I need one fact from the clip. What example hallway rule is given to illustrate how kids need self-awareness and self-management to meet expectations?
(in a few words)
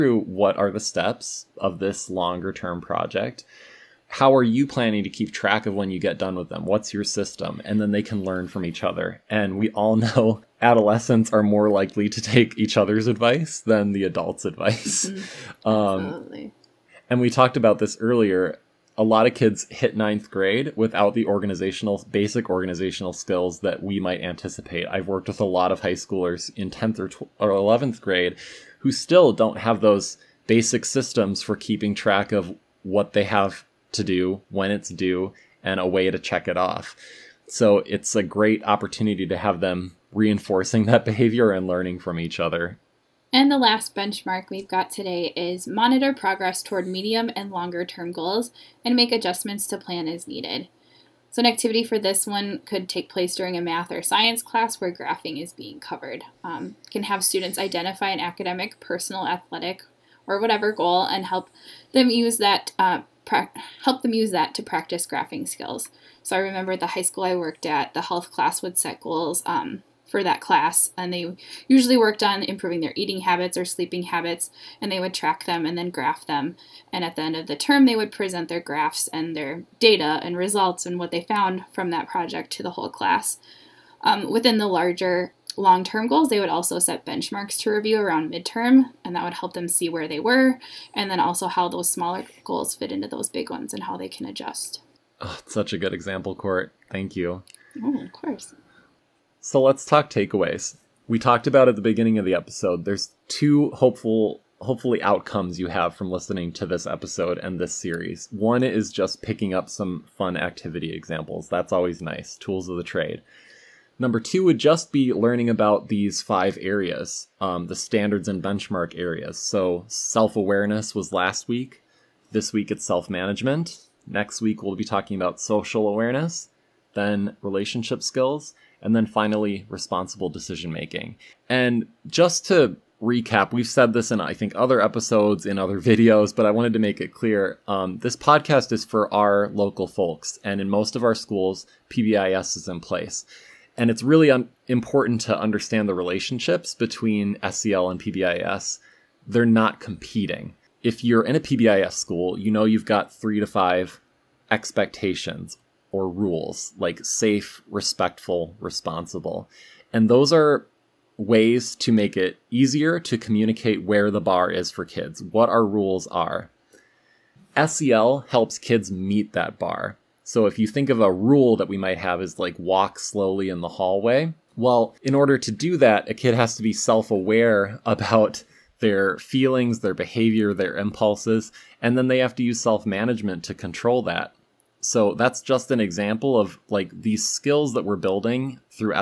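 Walk slowly in the hallway.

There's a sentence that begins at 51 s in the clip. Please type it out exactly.
So, an activity for this one could take place during a math or science class where graphing is being covered.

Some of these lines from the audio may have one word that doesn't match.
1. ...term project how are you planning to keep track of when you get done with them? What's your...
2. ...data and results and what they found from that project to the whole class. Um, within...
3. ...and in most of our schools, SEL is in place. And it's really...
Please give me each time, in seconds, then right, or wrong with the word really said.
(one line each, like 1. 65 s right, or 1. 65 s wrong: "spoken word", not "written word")
1. 2 s right
2. 79 s right
3. 140 s wrong: "PBIS", not "SEL".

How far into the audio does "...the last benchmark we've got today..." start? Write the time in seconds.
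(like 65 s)
43 s.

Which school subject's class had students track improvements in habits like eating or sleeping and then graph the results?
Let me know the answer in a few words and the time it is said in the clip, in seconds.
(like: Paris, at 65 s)
Health class, at 68 s.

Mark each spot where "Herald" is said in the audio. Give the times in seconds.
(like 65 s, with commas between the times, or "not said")
not said.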